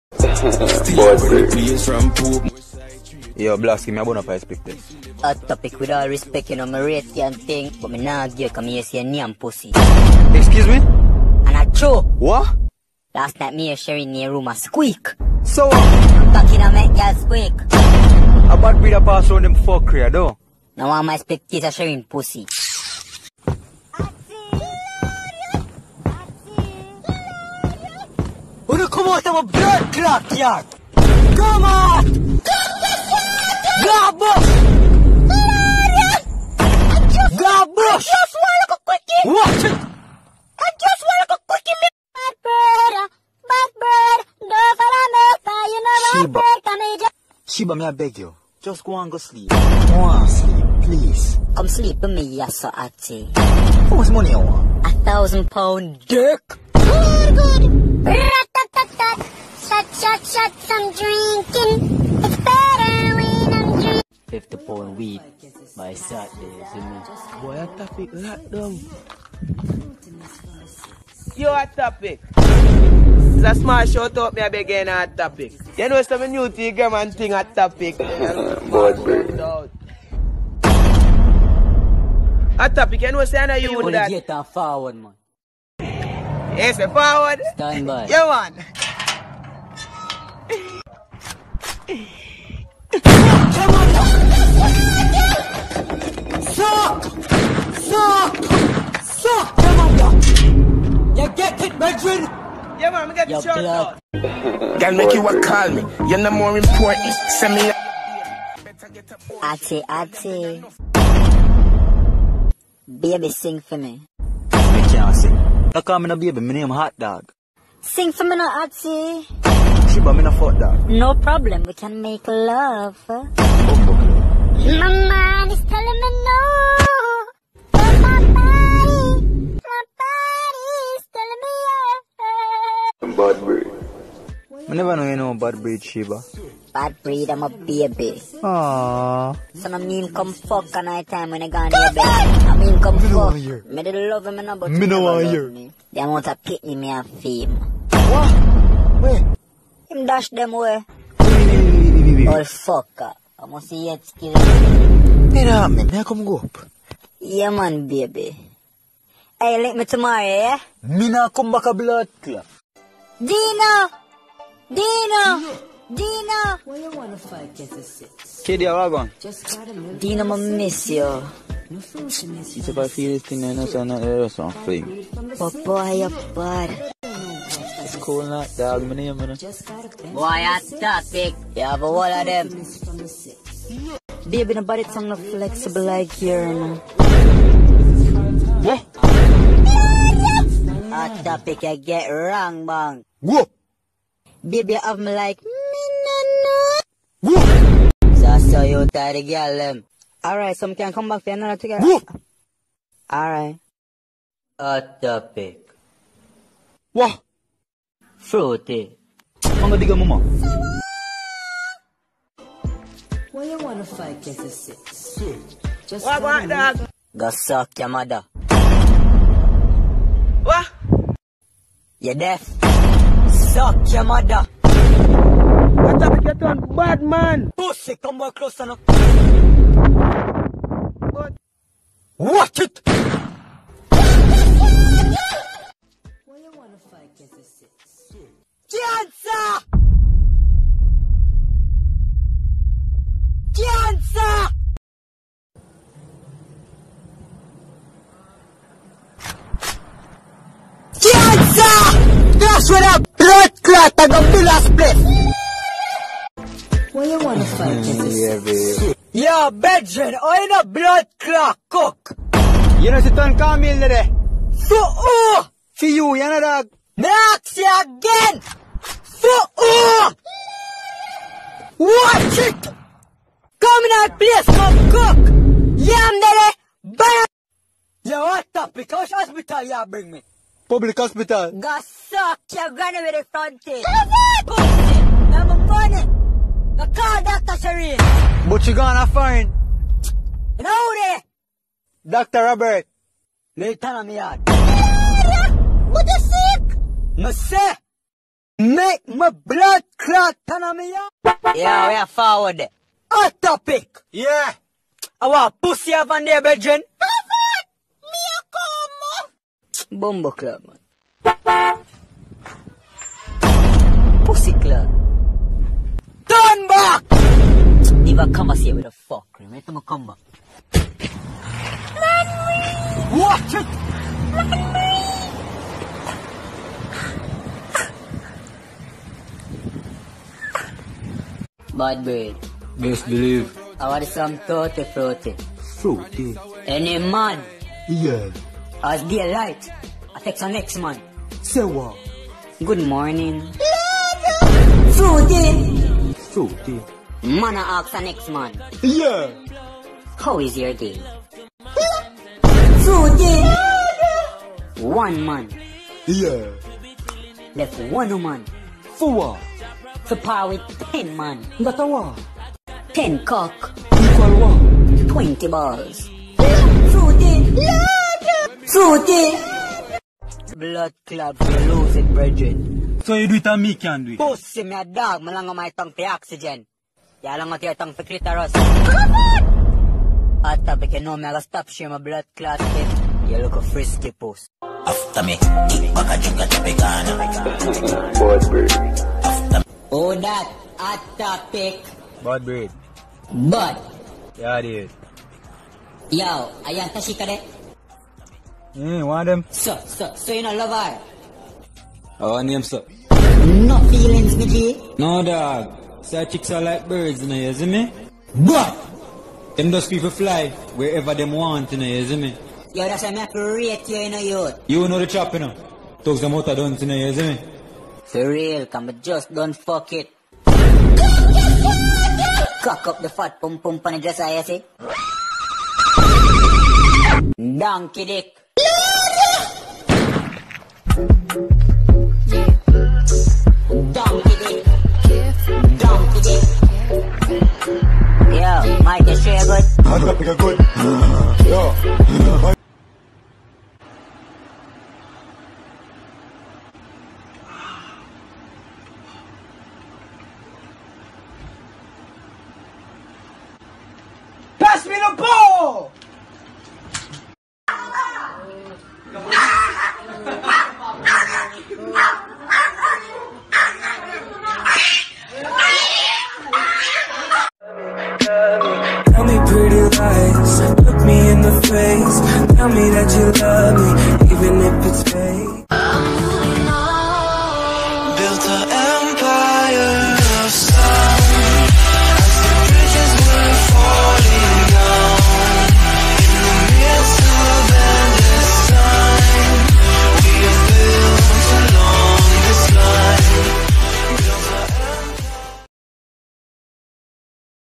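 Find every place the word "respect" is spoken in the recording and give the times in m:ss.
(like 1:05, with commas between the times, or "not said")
0:06.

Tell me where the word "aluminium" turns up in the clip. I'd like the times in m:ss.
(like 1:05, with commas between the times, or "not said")
2:58.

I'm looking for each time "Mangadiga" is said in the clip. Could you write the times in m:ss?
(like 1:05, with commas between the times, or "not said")
3:29.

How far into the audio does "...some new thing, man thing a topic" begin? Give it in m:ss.
1:16.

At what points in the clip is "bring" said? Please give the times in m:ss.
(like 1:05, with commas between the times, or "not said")
4:39.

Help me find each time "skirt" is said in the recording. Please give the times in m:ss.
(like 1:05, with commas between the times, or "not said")
not said.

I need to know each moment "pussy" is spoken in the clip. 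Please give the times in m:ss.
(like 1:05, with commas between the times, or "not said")
0:09, 0:22, 3:47, 4:43, 5:05, 5:14, 6:14.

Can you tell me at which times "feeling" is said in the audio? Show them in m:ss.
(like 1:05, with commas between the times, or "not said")
2:52, 6:43.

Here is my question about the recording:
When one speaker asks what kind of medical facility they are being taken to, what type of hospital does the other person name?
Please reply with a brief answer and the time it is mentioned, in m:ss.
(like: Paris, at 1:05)
Public hospital, at 4:40.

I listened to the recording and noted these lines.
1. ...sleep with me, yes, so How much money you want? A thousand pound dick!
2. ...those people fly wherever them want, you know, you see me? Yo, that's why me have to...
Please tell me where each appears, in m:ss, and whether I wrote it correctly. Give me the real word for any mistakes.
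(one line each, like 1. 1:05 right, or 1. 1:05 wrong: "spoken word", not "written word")
1. 0:51 right
2. 6:49 right.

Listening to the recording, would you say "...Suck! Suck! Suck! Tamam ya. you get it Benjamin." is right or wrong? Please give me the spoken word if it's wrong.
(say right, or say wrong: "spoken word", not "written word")
right.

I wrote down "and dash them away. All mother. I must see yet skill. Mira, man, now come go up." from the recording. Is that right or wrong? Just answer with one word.
wrong.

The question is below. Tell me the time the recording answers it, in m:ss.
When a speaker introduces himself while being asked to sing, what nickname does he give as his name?
1:56.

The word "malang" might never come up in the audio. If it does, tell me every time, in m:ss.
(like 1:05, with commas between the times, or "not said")
6:15.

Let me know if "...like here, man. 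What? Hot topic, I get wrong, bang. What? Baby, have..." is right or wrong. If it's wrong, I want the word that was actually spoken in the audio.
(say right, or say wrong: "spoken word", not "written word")
right.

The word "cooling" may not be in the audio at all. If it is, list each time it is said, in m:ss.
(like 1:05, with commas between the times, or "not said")
2:58.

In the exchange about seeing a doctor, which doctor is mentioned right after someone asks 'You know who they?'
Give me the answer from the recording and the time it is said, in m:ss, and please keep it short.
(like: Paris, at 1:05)
Dr. Robert, at 4:52.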